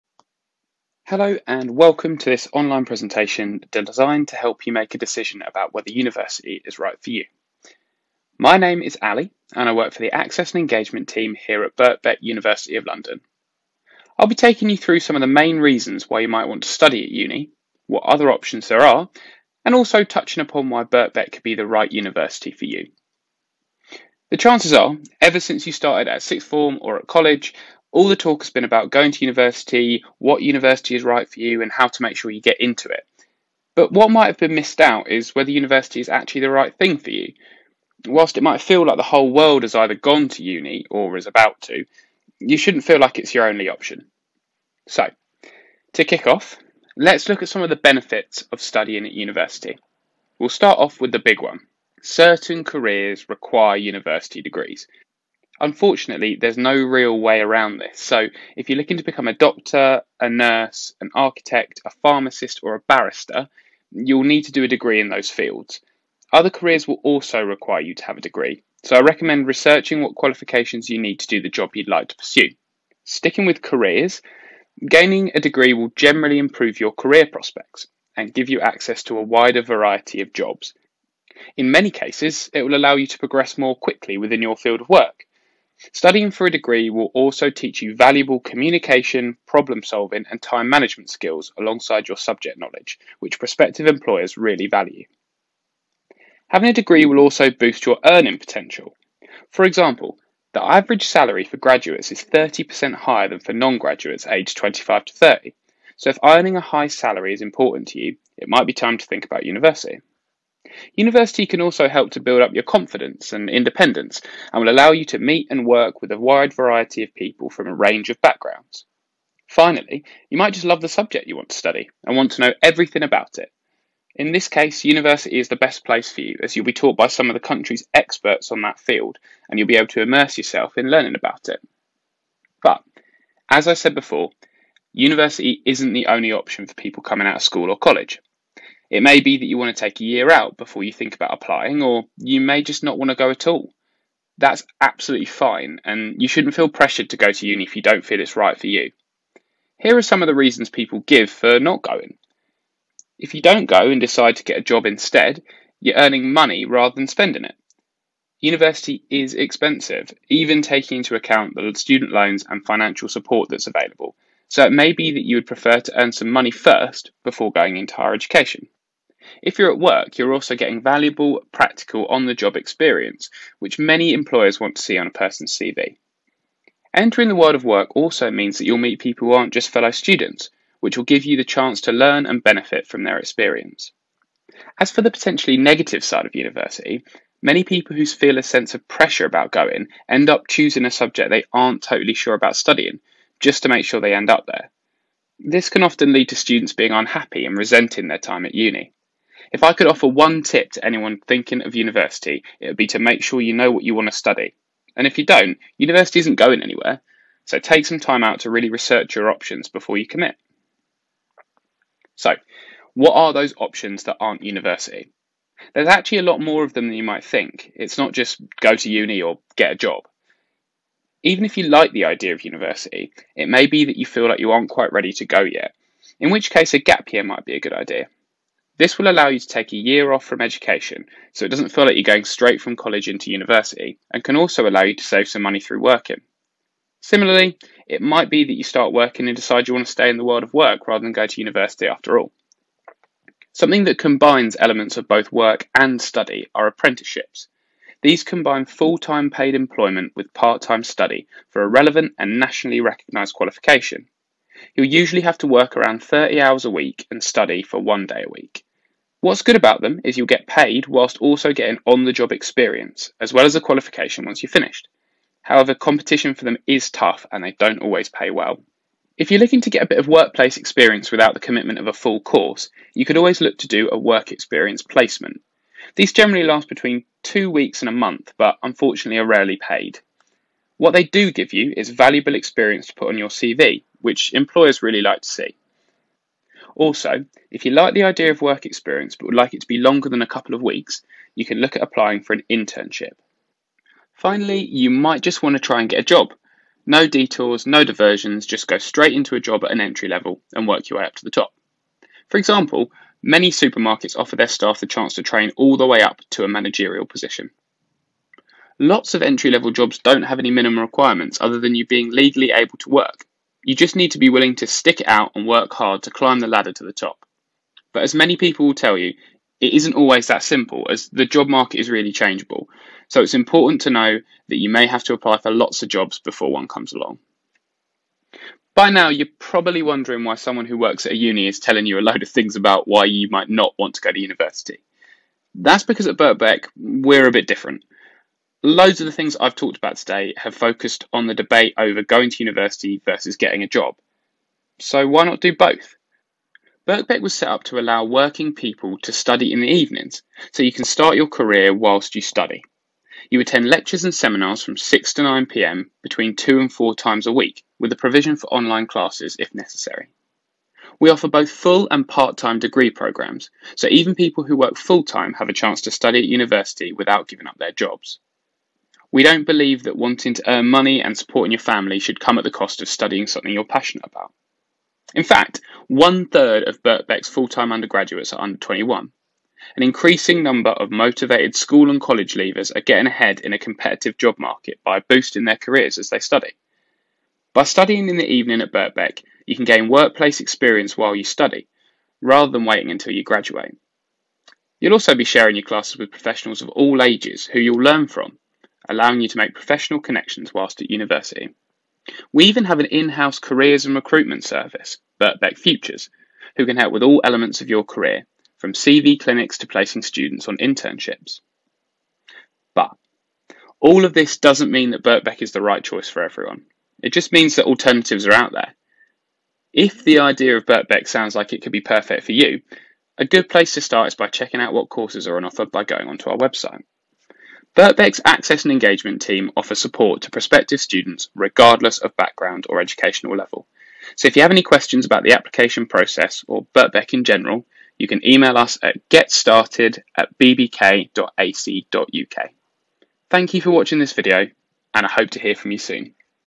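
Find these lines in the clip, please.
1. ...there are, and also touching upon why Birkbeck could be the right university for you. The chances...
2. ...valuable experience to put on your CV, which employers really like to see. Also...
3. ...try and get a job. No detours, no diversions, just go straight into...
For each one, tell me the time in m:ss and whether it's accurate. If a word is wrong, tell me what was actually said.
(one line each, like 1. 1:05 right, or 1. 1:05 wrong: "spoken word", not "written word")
1. 0:18 right
2. 4:41 right
3. 4:55 right.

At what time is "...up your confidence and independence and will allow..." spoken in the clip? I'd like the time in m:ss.
1:52.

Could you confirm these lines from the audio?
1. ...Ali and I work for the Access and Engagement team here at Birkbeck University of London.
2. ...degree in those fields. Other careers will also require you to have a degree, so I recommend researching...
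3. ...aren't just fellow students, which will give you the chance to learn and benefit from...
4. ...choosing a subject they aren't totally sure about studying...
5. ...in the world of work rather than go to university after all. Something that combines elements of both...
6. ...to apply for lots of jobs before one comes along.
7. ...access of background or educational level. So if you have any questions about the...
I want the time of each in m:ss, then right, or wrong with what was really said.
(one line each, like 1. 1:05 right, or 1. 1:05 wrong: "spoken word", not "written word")
1. 0:09 right
2. 1:04 right
3. 2:59 right
4. 3:10 right
5. 4:00 right
6. 5:25 right
7. 7:11 wrong: "regardless", not "access".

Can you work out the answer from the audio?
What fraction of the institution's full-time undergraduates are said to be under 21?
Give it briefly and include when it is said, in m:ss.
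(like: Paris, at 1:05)
one third, at 6:15.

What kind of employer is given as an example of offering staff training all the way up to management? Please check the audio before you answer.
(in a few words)
supermarkets.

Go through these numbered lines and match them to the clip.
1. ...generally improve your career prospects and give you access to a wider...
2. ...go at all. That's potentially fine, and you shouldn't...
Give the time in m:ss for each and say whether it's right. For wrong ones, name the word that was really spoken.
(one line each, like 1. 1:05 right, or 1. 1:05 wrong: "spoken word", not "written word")
1. 1:15 right
2. 2:23 wrong: "absolutely", not "potentially".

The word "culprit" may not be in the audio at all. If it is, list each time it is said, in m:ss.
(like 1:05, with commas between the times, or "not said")
not said.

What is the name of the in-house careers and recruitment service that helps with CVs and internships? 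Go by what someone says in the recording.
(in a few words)
Birkbeck Futures.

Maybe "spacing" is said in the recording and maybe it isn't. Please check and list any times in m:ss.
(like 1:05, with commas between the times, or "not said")
not said.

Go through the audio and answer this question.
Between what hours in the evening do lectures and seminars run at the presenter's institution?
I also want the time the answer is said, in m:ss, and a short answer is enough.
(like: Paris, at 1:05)
6 to 9 pm, at 5:54.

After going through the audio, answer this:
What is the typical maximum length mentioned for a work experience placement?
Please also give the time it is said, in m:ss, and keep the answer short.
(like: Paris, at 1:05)
a month, at 4:37.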